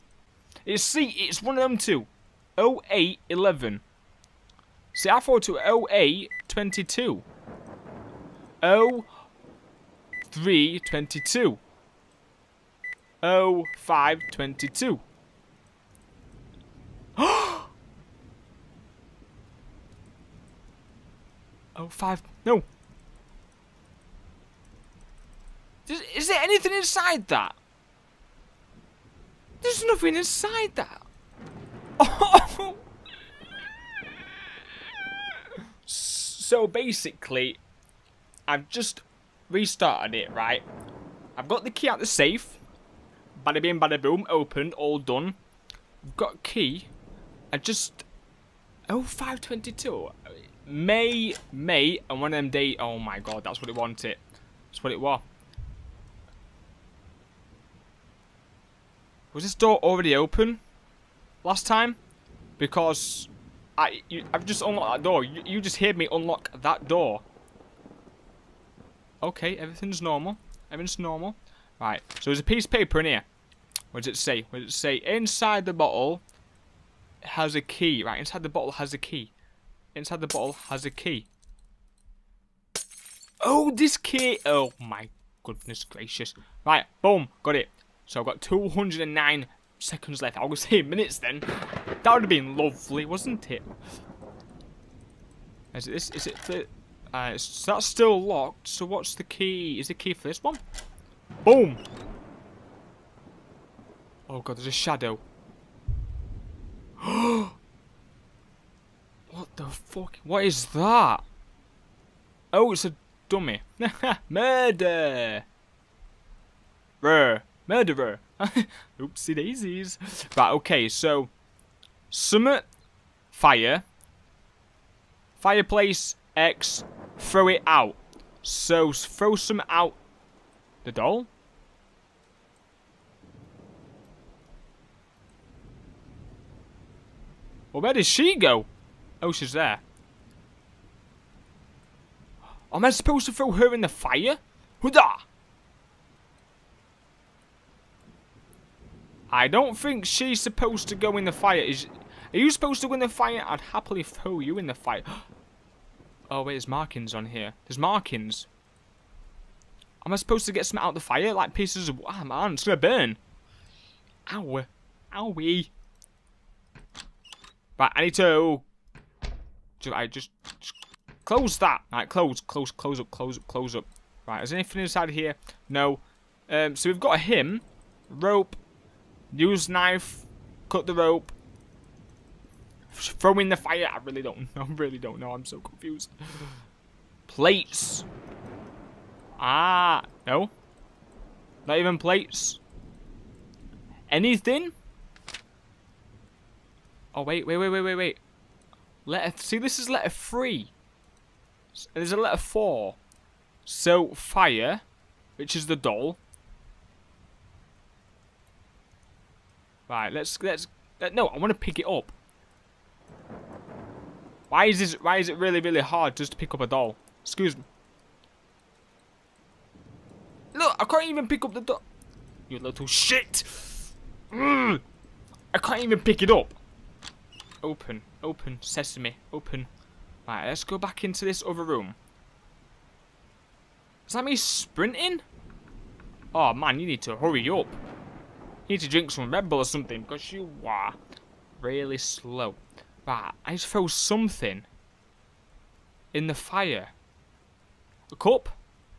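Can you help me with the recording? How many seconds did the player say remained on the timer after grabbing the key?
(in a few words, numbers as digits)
209.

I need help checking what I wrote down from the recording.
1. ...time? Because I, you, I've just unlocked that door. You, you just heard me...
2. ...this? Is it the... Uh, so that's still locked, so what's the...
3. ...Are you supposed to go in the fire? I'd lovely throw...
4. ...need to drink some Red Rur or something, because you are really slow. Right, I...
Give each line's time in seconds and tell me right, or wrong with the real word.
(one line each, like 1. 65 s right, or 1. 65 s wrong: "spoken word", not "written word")
1. 61 s right
2. 95 s right
3. 152 s wrong: "happily", not "lovely"
4. 238 s wrong: "Bull", not "Rur".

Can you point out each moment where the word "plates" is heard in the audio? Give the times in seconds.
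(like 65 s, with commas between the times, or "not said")
187 s, 191 s.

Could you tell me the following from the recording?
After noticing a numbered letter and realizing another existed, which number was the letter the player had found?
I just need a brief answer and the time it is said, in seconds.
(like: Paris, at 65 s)
3, at 200 s.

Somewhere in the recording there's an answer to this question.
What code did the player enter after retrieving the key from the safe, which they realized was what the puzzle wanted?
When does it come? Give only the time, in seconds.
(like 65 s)
48 s.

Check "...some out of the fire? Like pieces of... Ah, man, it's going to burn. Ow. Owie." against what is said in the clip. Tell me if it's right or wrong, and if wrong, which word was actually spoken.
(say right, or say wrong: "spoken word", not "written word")
right.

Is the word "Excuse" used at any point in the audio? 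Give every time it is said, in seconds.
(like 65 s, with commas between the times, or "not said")
217 s.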